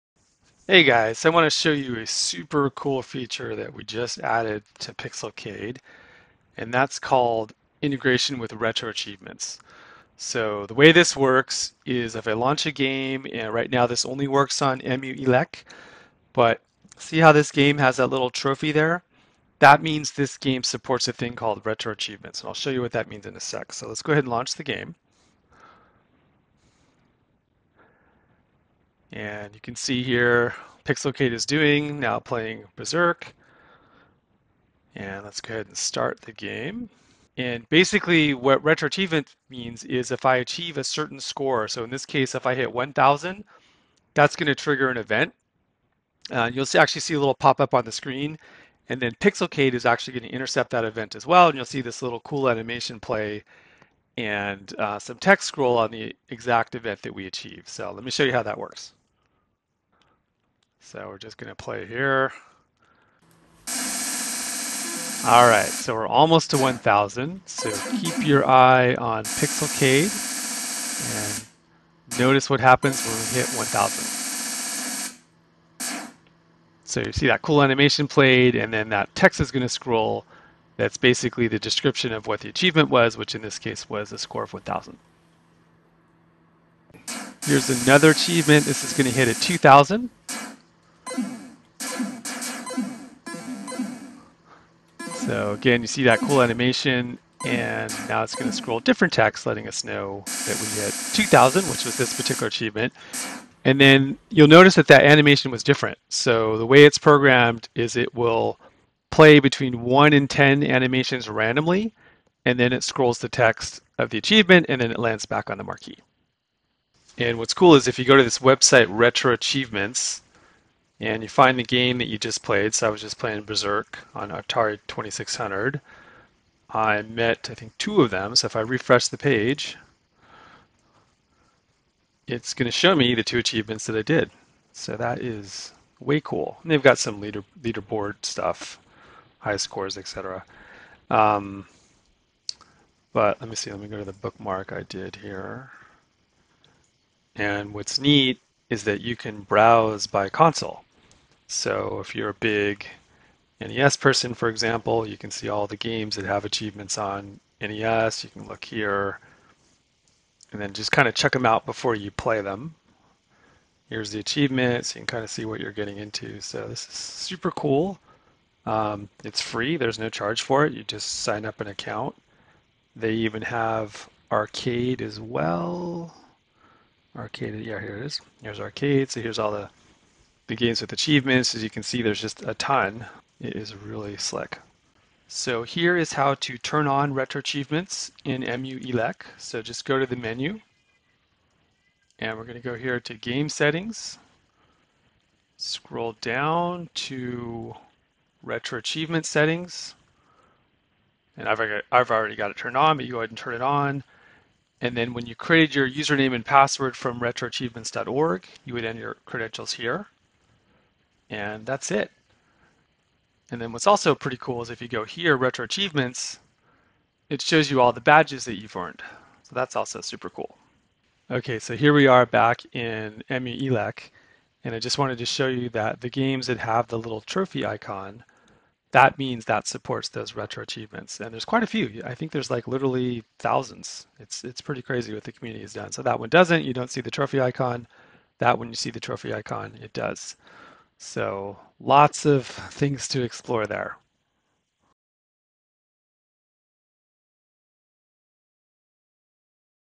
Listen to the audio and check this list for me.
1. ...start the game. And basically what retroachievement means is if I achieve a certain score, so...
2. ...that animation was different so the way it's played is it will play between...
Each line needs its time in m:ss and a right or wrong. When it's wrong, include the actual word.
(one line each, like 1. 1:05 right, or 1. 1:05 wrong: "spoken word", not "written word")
1. 0:35 right
2. 1:44 wrong: "programmed", not "played".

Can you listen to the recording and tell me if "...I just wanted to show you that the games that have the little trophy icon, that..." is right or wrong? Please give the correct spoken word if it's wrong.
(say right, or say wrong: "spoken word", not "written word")
right.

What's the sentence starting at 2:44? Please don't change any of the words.
You can kind of see what you're getting into.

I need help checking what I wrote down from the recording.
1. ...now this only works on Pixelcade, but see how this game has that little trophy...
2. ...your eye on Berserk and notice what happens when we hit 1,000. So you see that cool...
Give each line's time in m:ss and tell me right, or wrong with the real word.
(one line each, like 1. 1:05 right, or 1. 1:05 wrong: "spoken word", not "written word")
1. 0:13 wrong: "EmuELEC", not "Pixelcade"
2. 1:08 wrong: "Pixelcade", not "Berserk".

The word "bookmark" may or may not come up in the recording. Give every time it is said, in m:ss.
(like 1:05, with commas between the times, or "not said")
2:24.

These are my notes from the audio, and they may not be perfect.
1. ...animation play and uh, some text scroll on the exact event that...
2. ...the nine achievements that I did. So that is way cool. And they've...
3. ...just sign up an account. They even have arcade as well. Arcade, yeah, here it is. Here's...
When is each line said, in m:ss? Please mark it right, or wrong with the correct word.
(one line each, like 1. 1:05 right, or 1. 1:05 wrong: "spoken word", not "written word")
1. 0:52 right
2. 2:13 wrong: "two", not "nine"
3. 2:50 right.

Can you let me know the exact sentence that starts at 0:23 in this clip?
So let's go ahead and launch the game.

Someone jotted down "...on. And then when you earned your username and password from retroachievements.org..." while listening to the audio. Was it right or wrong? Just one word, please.
wrong.